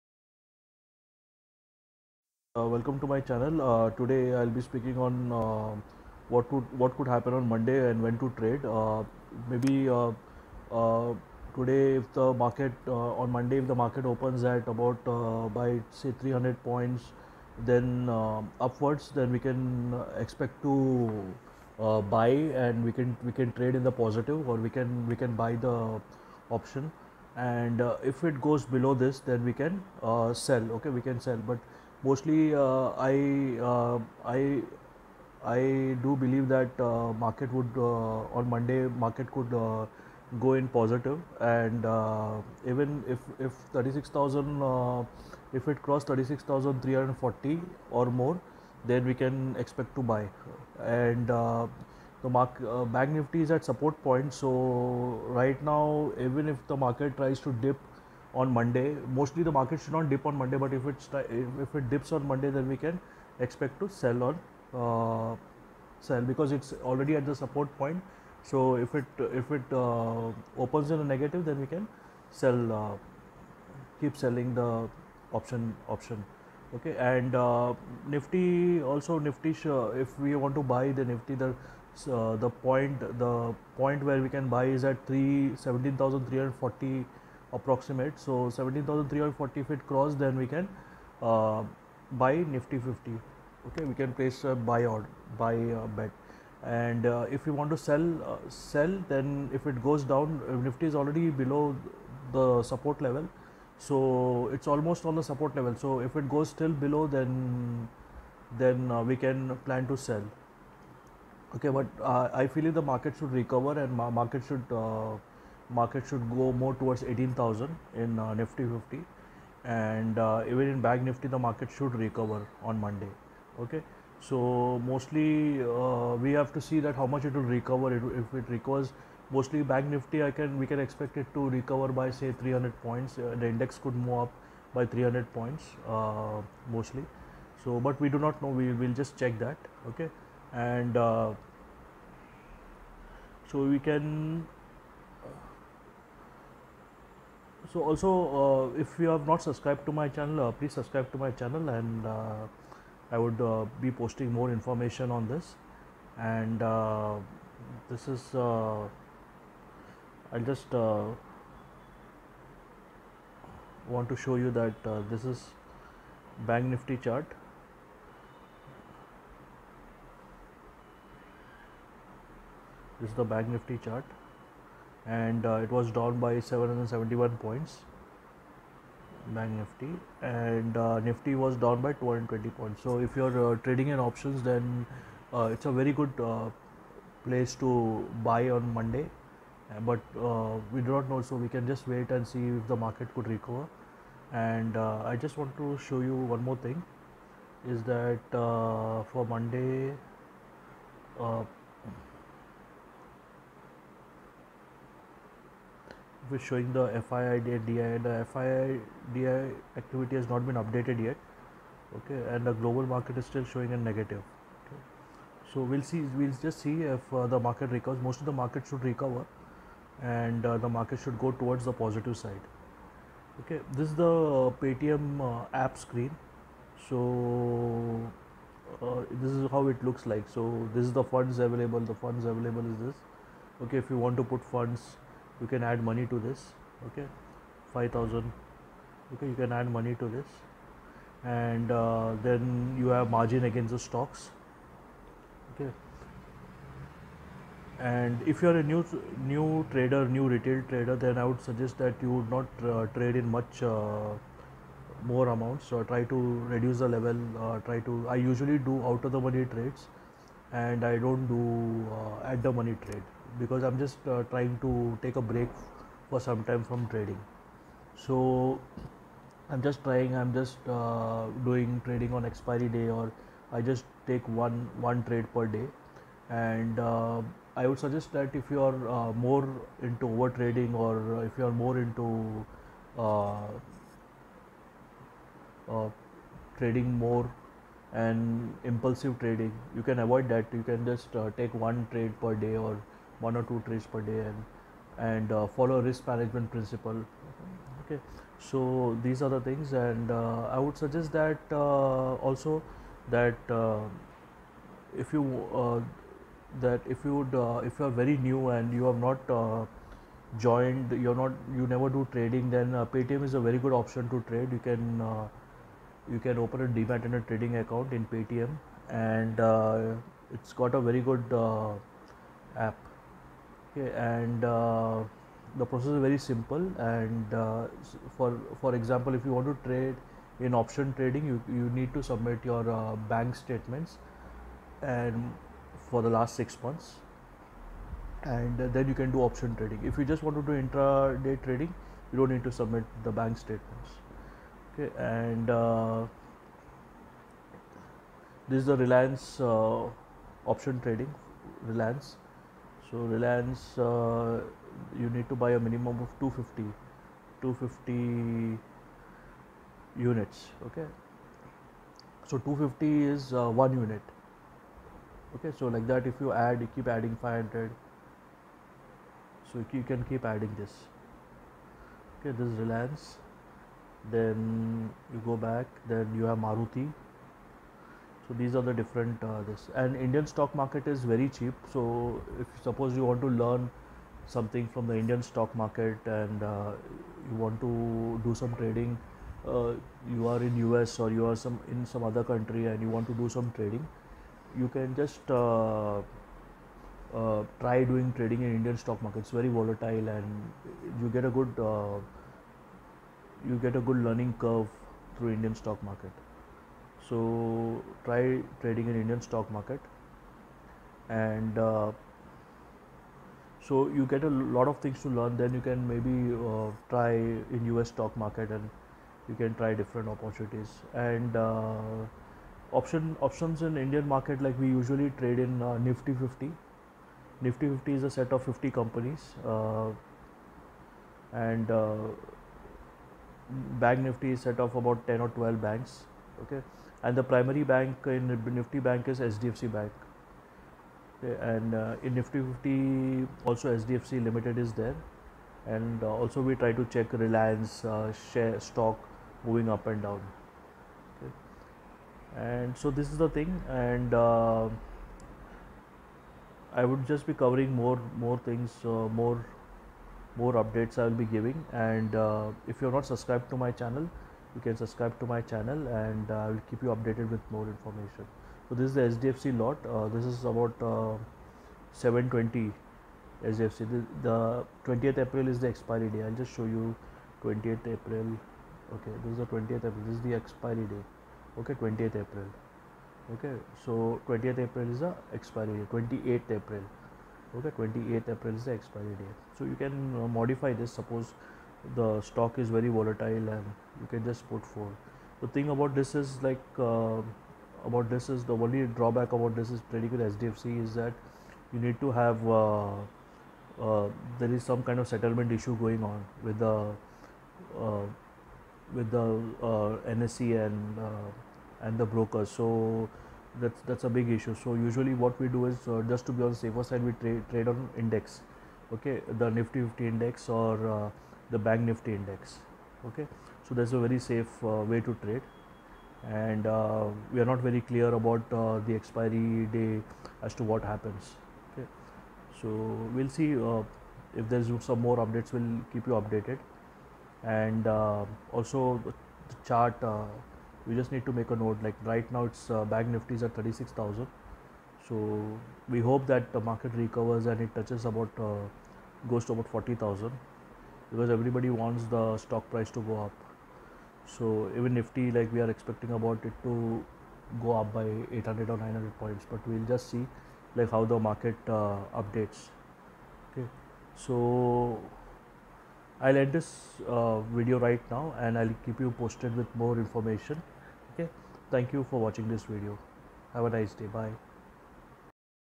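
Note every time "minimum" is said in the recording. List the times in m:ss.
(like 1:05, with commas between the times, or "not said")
5:55.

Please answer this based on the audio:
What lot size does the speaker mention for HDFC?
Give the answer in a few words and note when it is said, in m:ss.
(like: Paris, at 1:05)
720, at 7:51.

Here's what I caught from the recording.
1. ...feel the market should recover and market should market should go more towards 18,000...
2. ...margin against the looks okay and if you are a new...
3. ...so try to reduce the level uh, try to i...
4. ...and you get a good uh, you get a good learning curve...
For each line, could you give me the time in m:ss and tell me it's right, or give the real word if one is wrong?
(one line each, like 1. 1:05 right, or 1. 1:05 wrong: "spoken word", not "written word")
1. 1:52 right
2. 4:03 wrong: "stocks", not "looks"
3. 4:15 right
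4. 6:40 right.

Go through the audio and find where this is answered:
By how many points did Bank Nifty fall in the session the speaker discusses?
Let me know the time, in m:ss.
2:56.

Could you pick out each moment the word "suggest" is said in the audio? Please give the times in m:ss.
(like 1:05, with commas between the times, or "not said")
4:11, 4:37, 5:00.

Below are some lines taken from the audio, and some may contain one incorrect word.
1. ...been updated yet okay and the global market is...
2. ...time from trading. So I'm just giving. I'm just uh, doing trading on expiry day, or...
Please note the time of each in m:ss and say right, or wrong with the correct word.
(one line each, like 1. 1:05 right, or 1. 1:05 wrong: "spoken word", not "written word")
1. 3:30 right
2. 4:26 wrong: "trying", not "giving".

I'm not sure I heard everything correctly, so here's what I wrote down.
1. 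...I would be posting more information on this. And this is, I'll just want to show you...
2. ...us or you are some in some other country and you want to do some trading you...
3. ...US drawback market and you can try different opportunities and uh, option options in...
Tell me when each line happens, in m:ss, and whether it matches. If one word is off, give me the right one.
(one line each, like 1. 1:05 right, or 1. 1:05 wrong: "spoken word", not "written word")
1. 2:33 right
2. 6:30 right
3. 6:57 wrong: "stock", not "drawback".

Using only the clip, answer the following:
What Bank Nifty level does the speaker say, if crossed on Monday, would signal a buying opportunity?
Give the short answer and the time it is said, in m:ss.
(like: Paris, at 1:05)
36,340, at 0:46.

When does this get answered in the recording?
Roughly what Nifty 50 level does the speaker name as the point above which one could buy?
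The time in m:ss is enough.
1:28.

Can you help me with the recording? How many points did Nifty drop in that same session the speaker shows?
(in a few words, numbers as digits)
220.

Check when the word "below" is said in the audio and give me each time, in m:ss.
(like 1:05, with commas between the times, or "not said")
0:28, 1:41, 1:46.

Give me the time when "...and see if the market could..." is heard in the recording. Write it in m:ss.
3:12.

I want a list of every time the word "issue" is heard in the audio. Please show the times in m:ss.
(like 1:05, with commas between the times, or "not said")
8:25, 8:34.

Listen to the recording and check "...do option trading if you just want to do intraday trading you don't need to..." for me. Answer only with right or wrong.
right.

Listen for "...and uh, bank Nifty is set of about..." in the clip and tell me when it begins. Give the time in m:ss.
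7:11.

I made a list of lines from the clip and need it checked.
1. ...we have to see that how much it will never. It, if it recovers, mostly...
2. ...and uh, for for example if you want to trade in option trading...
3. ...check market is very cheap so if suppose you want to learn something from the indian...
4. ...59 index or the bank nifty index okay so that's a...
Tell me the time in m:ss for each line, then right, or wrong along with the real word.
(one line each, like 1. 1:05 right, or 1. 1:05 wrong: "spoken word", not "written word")
1. 2:06 wrong: "recover", not "never"
2. 5:26 right
3. 6:20 wrong: "stock", not "check"
4. 8:39 wrong: "50", not "59".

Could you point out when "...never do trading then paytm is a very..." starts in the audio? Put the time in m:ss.
5:11.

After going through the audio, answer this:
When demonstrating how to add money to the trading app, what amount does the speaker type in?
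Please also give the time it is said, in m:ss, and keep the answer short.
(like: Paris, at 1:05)
5000, at 3:57.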